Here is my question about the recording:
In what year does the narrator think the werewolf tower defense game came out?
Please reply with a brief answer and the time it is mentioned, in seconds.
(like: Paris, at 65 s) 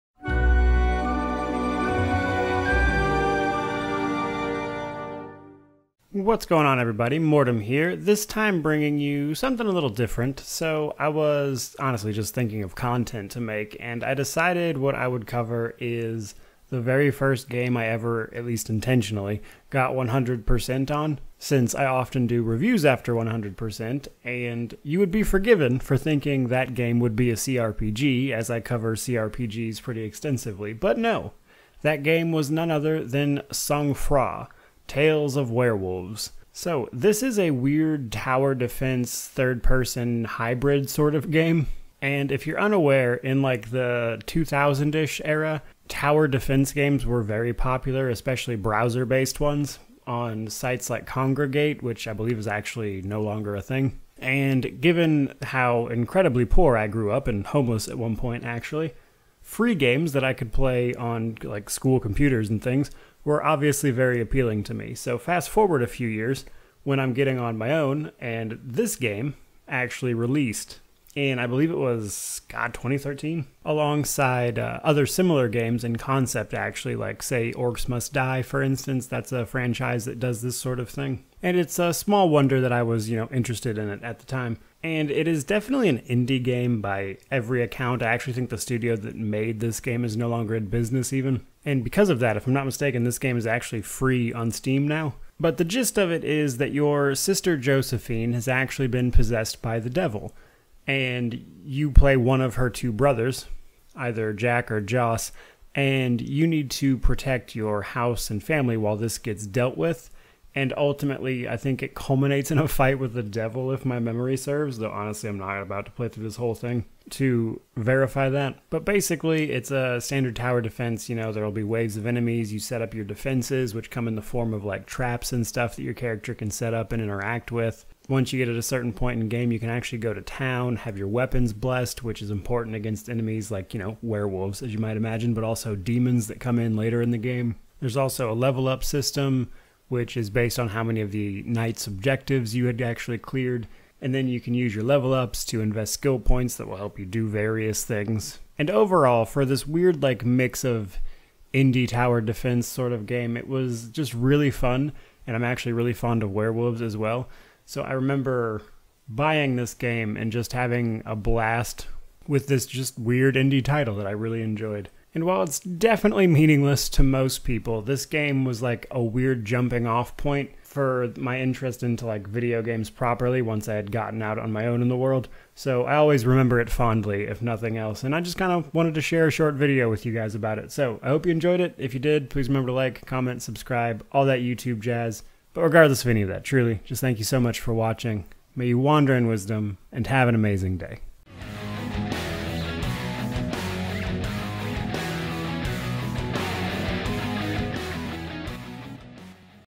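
2013, at 72 s.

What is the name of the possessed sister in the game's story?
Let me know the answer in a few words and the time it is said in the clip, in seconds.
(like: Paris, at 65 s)
Josephine, at 97 s.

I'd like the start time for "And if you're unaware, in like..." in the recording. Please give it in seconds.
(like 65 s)
42 s.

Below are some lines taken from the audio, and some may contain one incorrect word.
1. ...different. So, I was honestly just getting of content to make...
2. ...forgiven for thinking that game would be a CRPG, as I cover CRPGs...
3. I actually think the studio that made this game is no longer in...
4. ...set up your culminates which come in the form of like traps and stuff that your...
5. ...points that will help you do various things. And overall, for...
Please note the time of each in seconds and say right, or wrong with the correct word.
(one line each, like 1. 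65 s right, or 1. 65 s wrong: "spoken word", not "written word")
1. 9 s wrong: "thinking", not "getting"
2. 25 s right
3. 88 s right
4. 122 s wrong: "defenses", not "culminates"
5. 146 s right.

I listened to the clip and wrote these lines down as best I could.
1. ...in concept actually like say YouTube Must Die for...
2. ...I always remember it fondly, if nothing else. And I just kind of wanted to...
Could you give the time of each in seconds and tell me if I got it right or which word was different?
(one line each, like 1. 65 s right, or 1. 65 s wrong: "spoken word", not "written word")
1. 75 s wrong: "Orcs", not "YouTube"
2. 175 s right.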